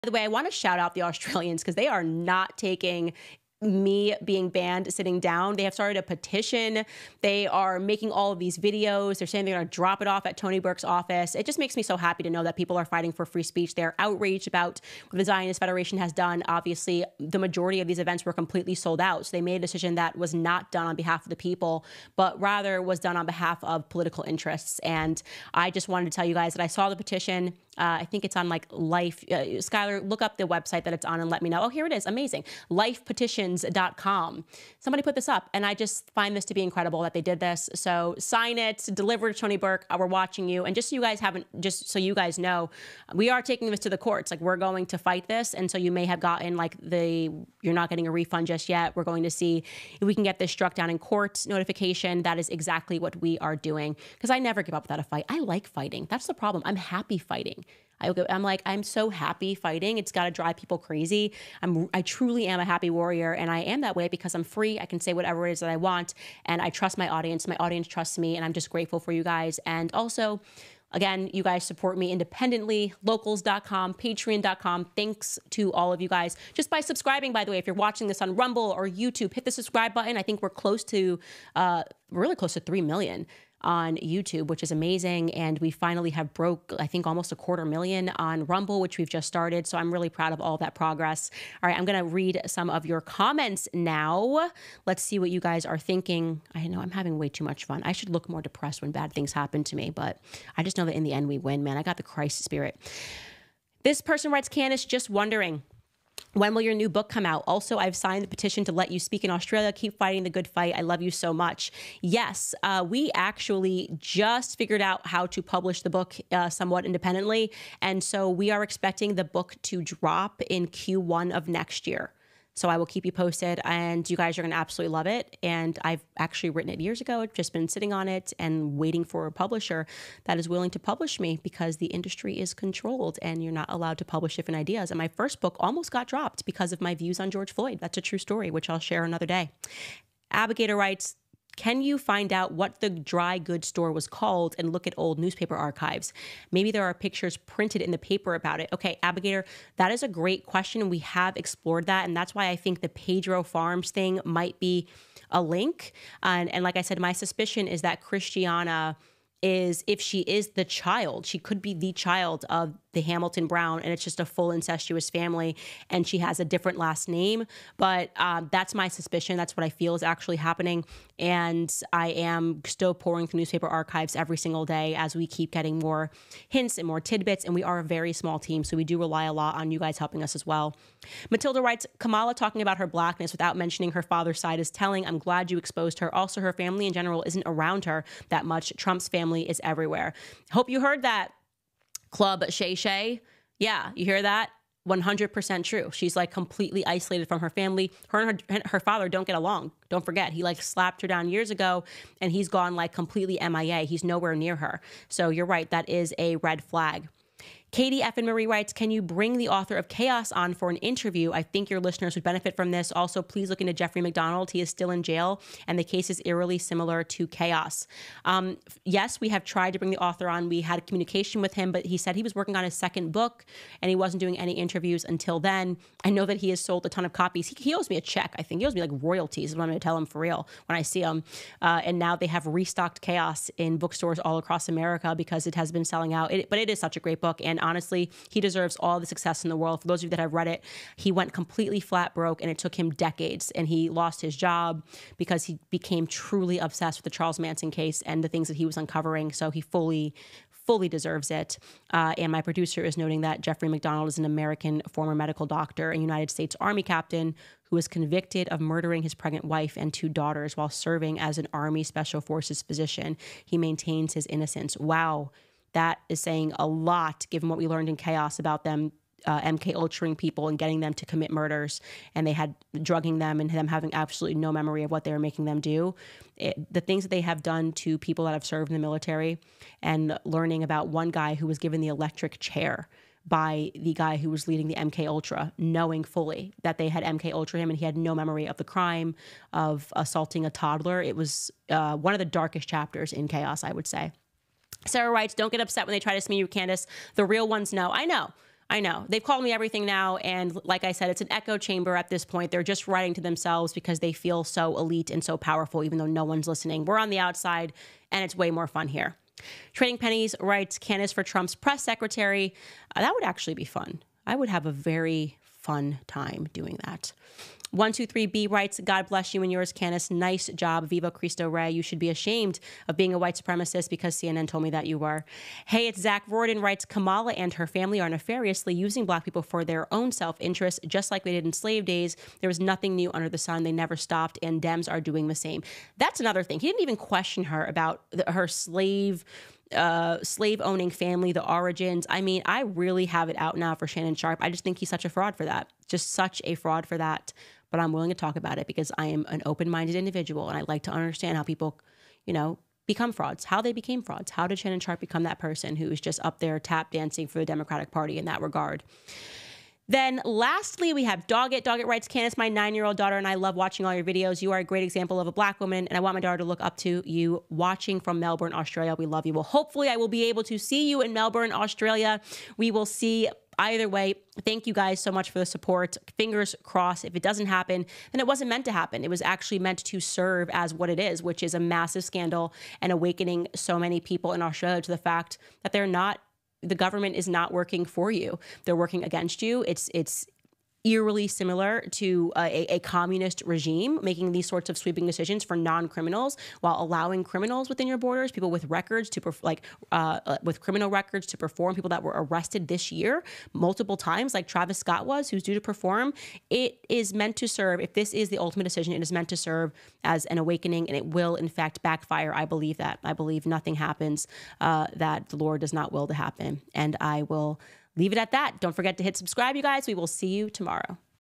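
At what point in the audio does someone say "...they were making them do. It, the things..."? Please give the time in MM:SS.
04:35.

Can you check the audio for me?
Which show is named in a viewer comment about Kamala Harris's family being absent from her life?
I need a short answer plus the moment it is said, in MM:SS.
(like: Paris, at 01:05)
Club Shay Shay, at 03:12.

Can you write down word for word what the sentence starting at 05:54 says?
How did Shannon Sharpe become that person who is just up there tap dancing for the Democratic Party in that regard?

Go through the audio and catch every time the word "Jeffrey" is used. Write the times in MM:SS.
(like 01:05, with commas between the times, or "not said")
03:33, 04:13.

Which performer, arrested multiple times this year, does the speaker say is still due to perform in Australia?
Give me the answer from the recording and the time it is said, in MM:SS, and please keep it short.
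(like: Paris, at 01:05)
Travis Scott, at 06:44.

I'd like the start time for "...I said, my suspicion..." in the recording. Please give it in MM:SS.
02:36.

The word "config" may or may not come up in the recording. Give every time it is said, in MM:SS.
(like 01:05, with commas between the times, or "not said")
not said.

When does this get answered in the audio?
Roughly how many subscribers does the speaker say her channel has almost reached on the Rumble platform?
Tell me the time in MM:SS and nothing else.
01:27.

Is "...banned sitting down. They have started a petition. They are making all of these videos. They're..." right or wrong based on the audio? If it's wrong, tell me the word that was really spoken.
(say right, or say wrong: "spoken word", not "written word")
right.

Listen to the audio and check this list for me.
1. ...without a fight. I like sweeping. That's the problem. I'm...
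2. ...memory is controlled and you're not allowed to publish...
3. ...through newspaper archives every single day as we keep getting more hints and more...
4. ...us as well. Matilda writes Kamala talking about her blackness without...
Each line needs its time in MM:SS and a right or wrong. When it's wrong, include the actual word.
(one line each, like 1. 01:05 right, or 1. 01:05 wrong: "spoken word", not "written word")
1. 00:54 wrong: "fighting", not "sweeping"
2. 02:11 wrong: "industry", not "memory"
3. 02:53 right
4. 03:00 right.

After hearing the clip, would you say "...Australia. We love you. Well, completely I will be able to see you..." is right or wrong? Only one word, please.
wrong.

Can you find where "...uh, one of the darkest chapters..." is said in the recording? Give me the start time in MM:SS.
04:51.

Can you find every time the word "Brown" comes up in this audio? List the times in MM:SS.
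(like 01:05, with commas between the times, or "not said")
02:43.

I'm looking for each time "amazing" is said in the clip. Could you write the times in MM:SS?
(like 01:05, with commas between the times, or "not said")
00:32, 01:24.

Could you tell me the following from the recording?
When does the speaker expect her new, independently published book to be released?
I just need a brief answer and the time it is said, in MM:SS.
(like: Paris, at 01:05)
Q1 of next year, at 02:00.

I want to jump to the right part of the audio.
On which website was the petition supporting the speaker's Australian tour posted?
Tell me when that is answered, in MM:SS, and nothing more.
00:32.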